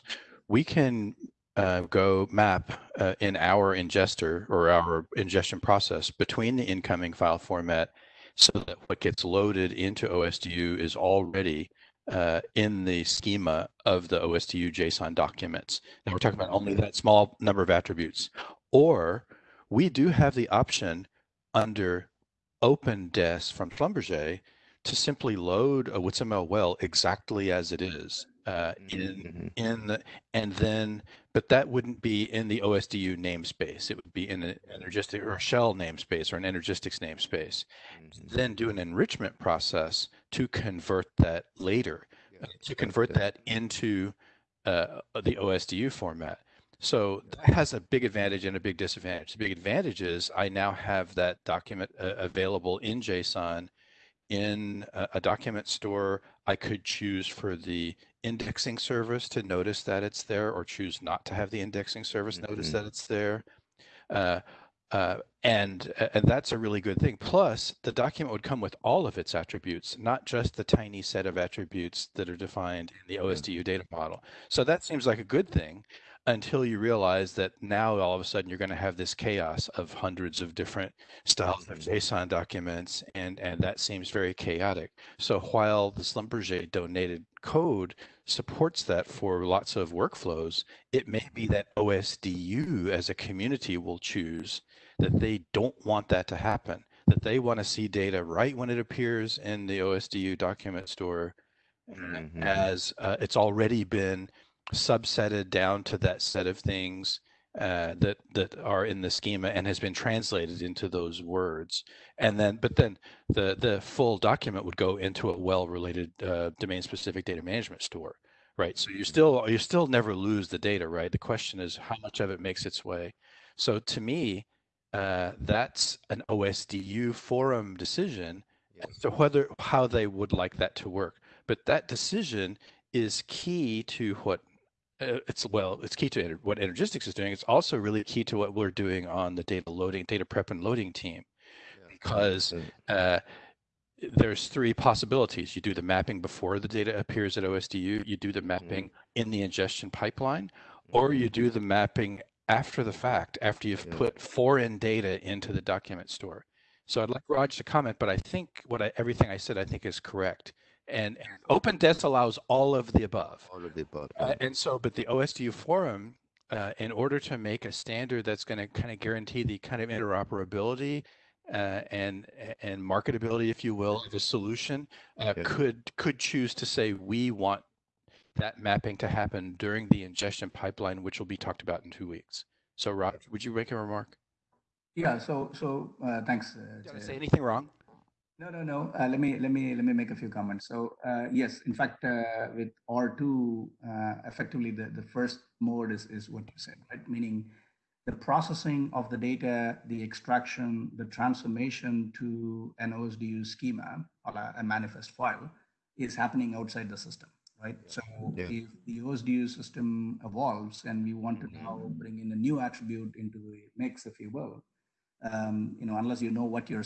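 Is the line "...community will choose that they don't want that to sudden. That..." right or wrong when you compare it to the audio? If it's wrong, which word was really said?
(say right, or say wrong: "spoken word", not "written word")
wrong: "happen", not "sudden".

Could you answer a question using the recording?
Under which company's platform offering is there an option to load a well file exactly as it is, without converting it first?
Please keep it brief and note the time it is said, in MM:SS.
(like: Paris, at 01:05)
OpenDES, at 00:22.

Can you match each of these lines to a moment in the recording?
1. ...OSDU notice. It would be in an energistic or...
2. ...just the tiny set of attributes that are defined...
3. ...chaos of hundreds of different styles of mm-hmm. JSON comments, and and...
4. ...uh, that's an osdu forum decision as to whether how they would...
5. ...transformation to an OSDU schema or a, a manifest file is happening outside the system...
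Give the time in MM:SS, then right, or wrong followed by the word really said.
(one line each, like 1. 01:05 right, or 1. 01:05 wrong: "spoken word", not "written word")
1. 00:32 wrong: "namespace", not "notice"
2. 01:10 right
3. 01:19 wrong: "documents", not "comments"
4. 02:04 right
5. 03:21 right.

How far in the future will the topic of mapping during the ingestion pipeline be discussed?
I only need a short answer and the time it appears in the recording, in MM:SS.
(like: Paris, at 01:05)
two weeks, at 03:01.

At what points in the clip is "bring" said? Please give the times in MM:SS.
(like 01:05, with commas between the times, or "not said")
03:31.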